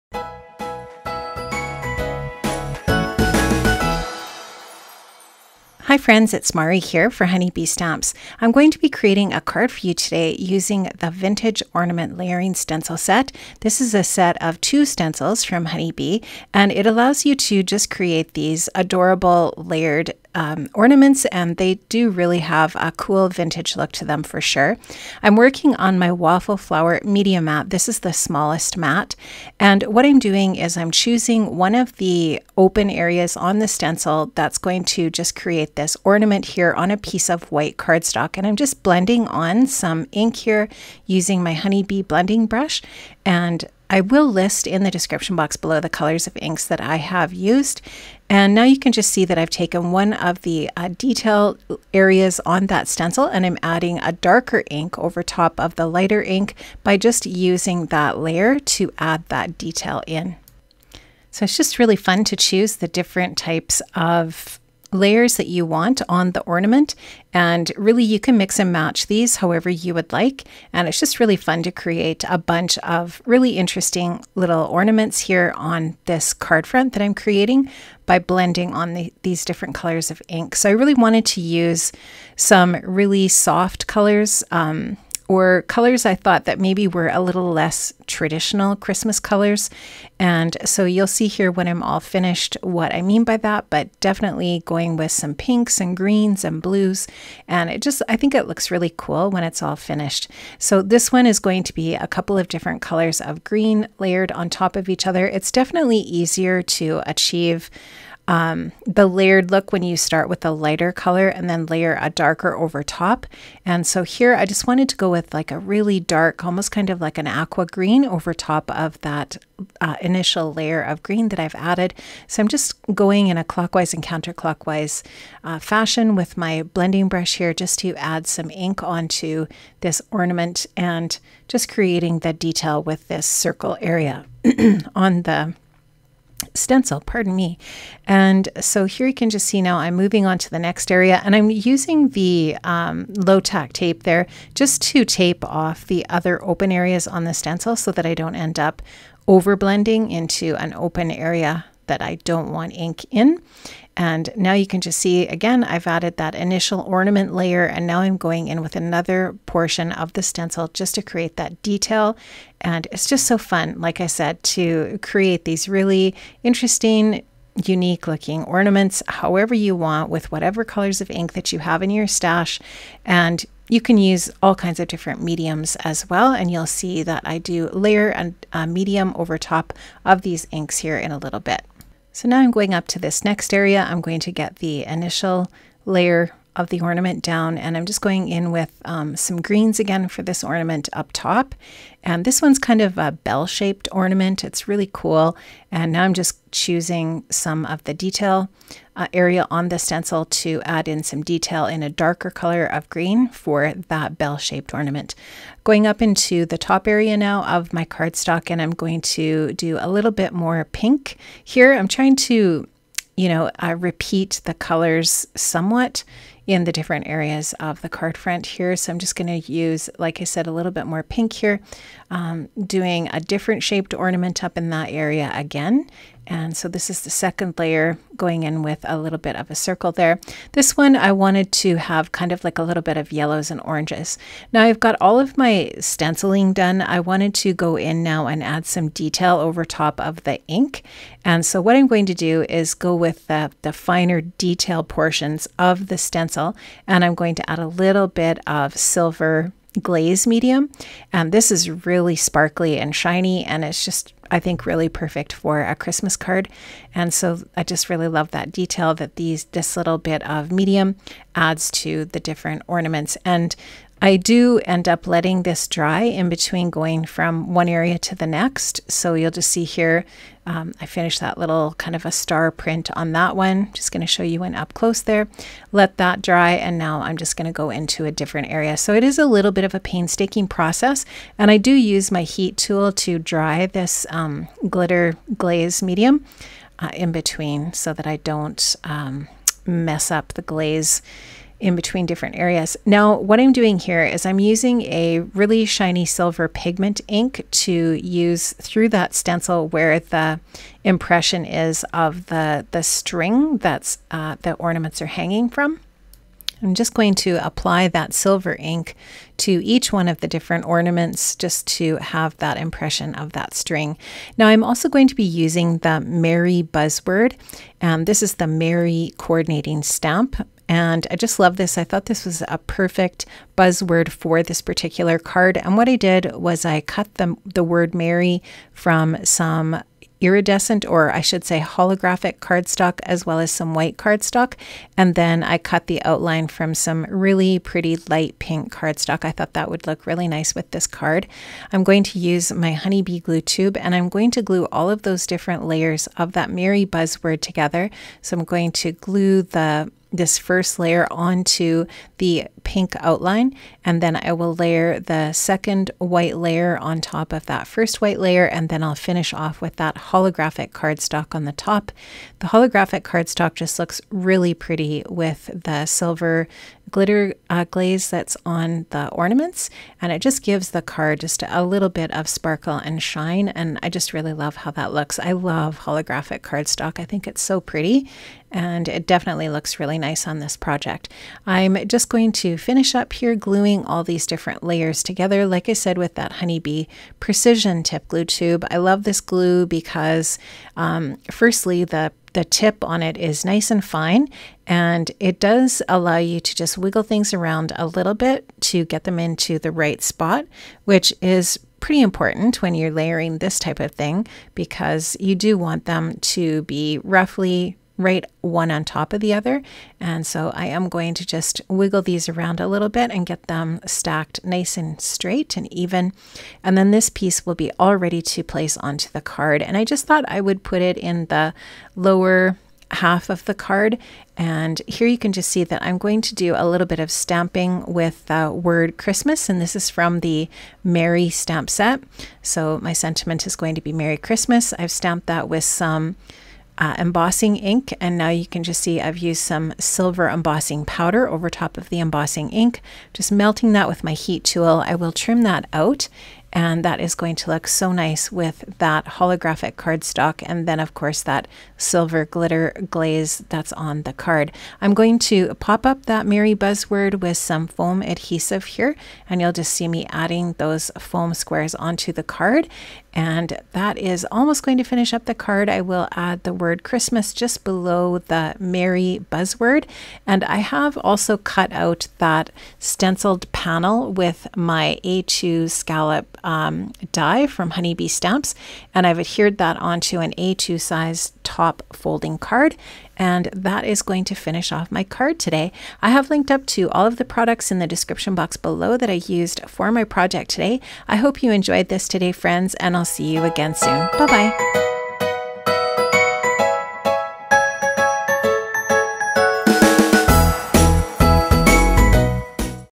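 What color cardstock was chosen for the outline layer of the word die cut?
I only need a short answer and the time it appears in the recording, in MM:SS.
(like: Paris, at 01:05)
Light pink, at 05:38.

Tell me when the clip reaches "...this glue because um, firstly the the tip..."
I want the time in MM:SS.
06:29.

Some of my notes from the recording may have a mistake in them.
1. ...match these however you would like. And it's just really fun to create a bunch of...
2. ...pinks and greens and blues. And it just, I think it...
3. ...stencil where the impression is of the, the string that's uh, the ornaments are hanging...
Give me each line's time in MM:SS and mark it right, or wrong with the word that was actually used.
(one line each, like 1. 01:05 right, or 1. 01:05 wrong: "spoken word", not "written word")
1. 01:08 right
2. 01:35 right
3. 04:59 right.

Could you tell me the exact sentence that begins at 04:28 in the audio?
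So you'll just see here, um, I finished that little kind of a star print on that one.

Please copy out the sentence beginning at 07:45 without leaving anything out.
I will add the word Christmas just below the Merry buzzword.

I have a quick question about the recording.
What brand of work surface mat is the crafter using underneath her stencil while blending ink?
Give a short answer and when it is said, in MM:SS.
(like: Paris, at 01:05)
Waffle Flower, at 00:26.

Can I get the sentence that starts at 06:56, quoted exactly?
And then this piece will be all ready to place onto the card.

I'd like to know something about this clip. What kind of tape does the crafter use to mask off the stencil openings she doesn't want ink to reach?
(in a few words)
Low tack tape.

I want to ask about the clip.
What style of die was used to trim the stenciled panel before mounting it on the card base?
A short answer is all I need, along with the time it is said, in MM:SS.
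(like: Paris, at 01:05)
A2 scallop die, at 07:55.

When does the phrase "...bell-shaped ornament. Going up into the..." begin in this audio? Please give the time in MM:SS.
03:24.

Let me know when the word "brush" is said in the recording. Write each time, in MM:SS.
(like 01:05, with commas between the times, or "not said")
00:42, 02:07.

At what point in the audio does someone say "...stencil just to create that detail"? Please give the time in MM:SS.
02:40.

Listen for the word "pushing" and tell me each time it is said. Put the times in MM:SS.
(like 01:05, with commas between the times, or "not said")
not said.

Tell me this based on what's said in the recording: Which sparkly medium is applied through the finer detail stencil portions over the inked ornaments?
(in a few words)
Silver glaze medium.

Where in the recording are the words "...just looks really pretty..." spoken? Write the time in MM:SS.
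06:03.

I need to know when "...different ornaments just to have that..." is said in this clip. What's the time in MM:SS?
05:10.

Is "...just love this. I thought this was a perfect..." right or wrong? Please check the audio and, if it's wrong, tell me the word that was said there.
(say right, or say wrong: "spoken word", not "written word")
right.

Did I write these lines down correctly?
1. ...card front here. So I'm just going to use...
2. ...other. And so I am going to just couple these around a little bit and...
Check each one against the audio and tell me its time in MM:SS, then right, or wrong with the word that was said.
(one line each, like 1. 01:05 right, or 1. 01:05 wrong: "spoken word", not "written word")
1. 03:37 right
2. 06:49 wrong: "wiggle", not "couple".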